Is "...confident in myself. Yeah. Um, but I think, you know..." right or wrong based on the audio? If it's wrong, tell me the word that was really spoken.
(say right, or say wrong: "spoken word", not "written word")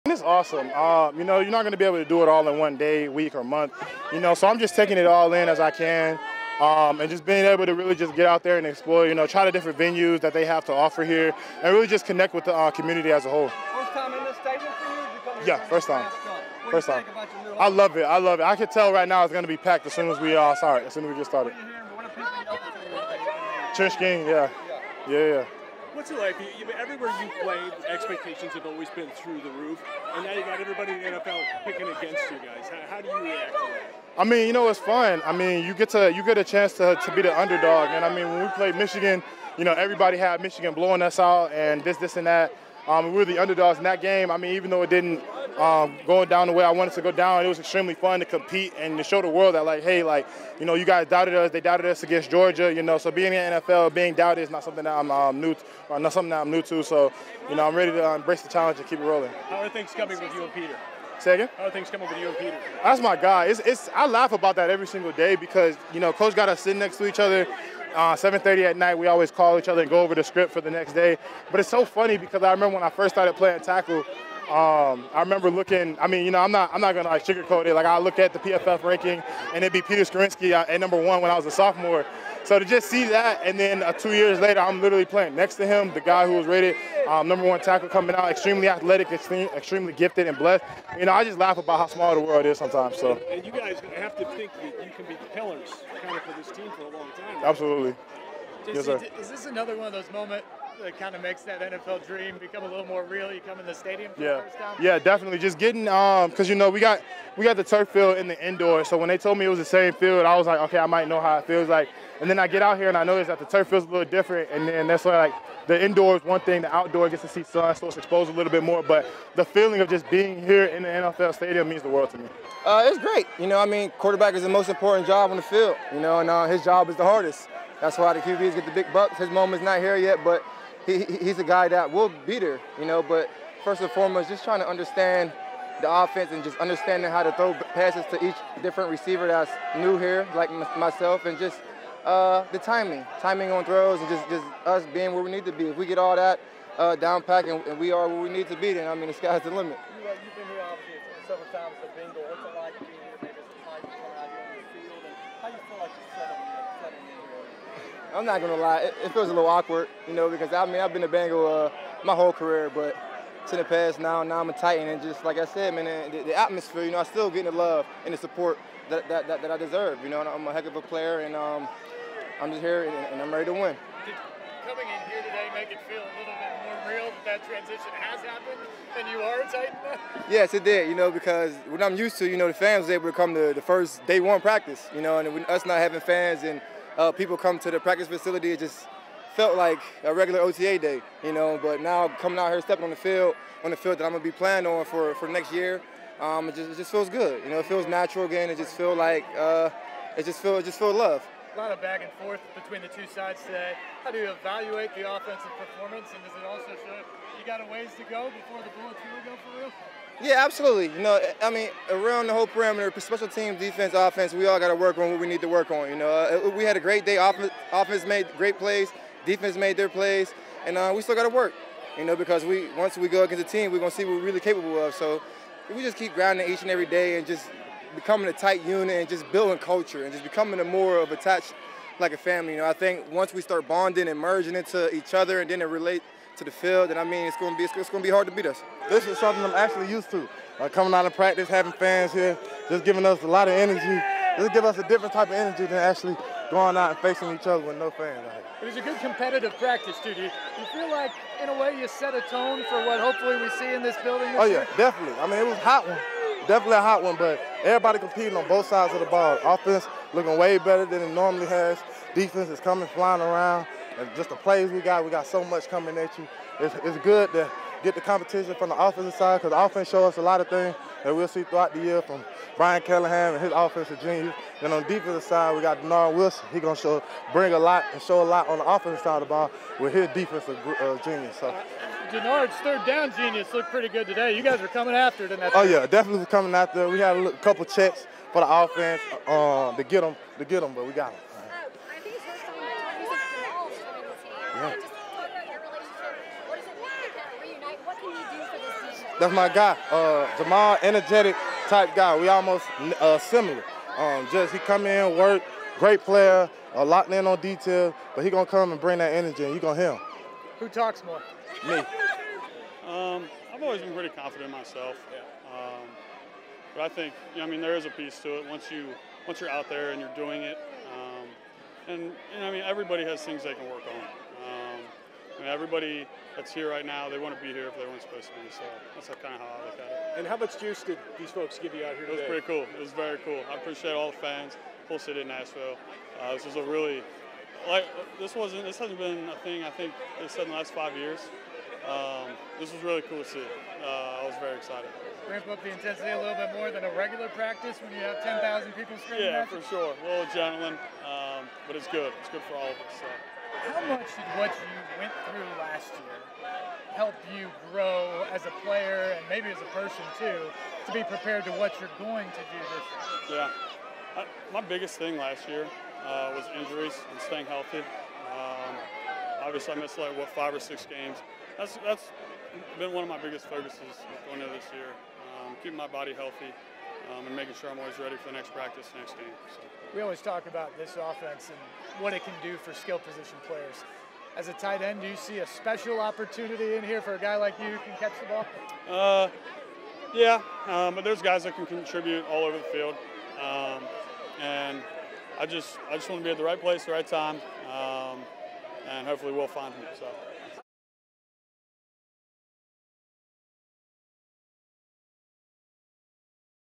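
right.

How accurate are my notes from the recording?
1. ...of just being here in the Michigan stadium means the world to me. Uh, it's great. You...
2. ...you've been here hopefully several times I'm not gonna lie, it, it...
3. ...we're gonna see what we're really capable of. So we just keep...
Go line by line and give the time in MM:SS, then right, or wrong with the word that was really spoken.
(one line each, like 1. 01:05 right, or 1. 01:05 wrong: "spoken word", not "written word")
1. 01:59 wrong: "NFL", not "Michigan"
2. 02:30 wrong: "obviously", not "hopefully"
3. 03:43 right.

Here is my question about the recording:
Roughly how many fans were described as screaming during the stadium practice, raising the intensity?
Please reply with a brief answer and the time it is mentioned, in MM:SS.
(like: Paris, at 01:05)
10,000, at 05:48.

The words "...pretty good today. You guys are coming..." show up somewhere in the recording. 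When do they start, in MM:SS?
04:43.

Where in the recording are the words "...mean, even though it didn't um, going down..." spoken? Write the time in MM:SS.
00:44.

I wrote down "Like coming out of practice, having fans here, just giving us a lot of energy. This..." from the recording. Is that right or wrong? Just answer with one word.
right.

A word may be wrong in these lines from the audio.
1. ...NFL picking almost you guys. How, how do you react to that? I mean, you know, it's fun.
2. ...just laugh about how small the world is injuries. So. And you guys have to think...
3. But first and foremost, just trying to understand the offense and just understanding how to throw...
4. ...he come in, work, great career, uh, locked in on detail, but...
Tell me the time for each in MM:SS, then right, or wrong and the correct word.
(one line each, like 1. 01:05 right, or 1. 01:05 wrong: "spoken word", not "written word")
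1. 00:31 wrong: "against", not "almost"
2. 01:31 wrong: "sometimes", not "injuries"
3. 02:13 right
4. 05:04 wrong: "player", not "career".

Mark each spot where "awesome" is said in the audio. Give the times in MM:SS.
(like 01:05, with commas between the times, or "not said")
00:00.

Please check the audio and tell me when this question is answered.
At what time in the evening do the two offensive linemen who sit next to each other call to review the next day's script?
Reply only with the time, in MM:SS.
01:08.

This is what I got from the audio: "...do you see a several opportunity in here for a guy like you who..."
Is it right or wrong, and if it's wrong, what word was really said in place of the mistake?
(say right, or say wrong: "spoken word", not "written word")
wrong: "special", not "several".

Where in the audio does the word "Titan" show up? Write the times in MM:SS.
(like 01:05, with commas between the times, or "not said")
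02:44, 02:59.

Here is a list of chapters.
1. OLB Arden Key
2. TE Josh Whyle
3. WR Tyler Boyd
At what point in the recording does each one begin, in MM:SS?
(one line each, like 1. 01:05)
1. 03:59
2. 05:12
3. 02:02.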